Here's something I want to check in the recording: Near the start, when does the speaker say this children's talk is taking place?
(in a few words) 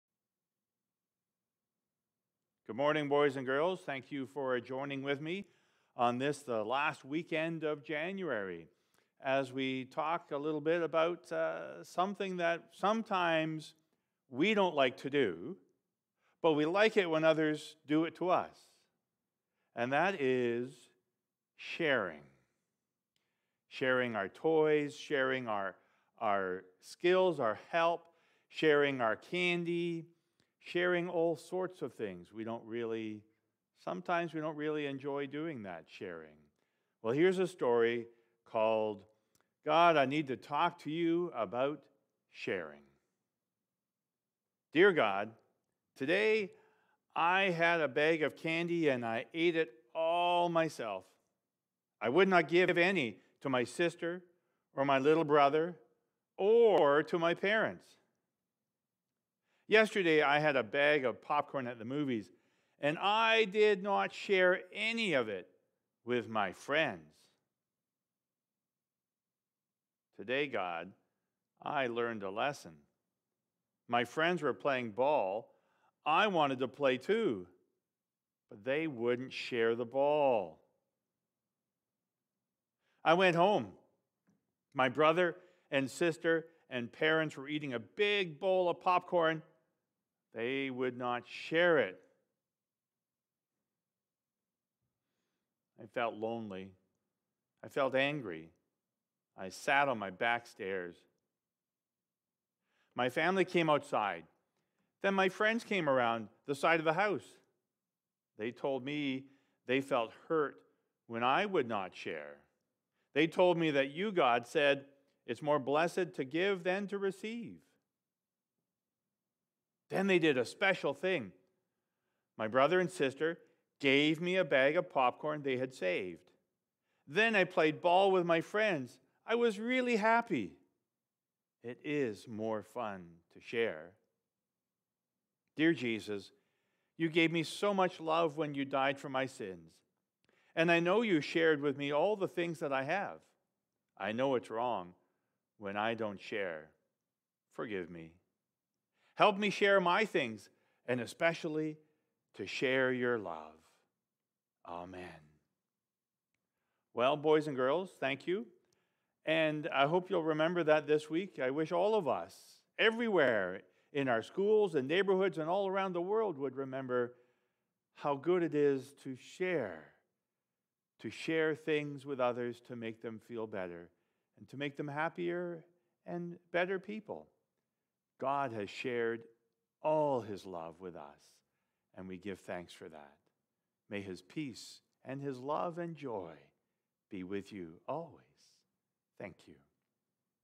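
Last weekend of January.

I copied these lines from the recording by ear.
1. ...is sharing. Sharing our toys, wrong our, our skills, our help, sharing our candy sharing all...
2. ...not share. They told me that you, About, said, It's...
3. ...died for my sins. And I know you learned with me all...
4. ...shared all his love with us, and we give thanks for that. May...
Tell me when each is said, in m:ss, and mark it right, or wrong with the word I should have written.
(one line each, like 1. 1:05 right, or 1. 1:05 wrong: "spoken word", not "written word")
1. 0:20 wrong: "sharing", not "wrong"
2. 1:51 wrong: "God", not "About"
3. 2:18 wrong: "shared", not "learned"
4. 2:58 right.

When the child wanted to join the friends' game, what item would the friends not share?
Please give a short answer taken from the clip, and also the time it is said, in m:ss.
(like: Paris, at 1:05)
The ball, at 1:18.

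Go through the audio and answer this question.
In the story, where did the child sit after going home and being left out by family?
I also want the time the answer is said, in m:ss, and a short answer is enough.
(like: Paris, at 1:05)
Back stairs, at 1:40.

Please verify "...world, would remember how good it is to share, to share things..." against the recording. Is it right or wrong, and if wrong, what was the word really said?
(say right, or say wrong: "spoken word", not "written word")
right.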